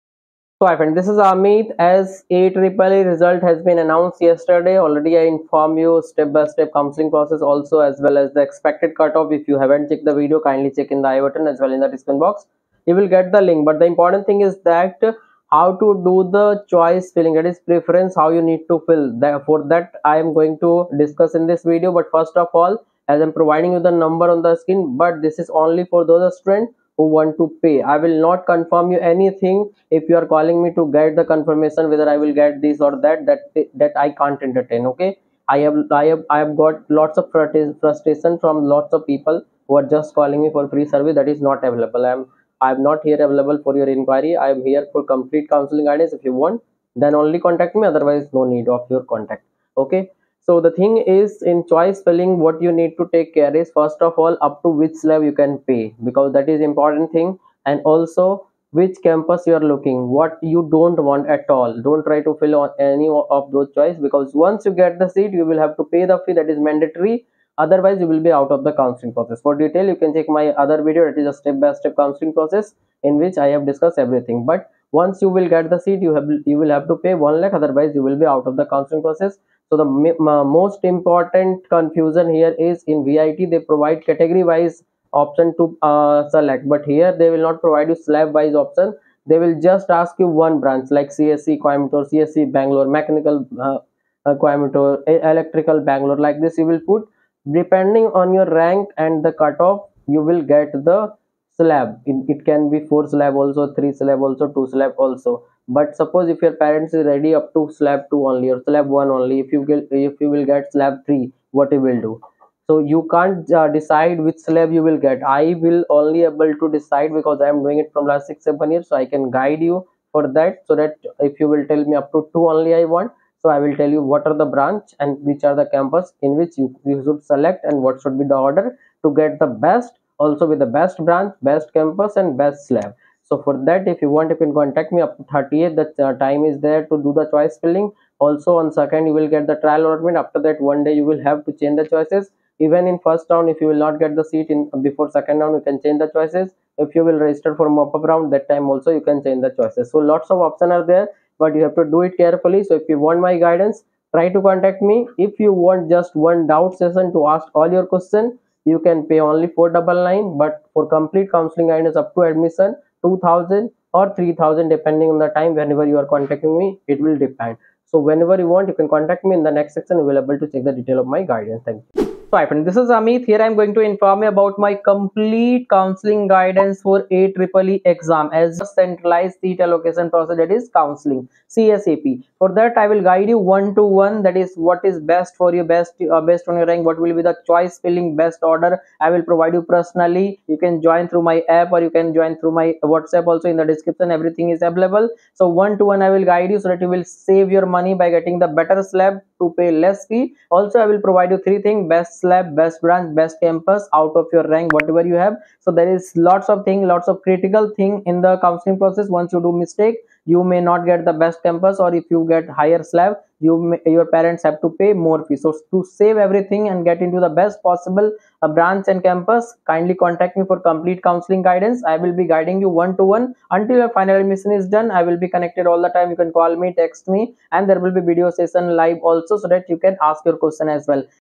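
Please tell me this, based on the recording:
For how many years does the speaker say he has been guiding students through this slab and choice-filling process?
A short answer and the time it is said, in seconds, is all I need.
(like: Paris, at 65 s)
six seven years, at 118 s.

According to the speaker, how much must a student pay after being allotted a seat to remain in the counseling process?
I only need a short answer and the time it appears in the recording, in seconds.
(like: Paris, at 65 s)
1 lakh, at 77 s.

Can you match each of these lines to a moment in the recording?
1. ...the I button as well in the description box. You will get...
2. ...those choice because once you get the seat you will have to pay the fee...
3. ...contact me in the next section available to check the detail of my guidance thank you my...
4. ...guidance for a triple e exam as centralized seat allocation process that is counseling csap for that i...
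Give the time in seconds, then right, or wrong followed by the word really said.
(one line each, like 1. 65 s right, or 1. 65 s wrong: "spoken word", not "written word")
1. 11 s right
2. 63 s right
3. 168 s right
4. 176 s right.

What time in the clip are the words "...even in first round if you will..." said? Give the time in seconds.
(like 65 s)
142 s.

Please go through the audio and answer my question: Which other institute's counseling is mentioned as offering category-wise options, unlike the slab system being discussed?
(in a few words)
VIT.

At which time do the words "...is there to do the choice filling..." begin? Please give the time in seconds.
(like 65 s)
136 s.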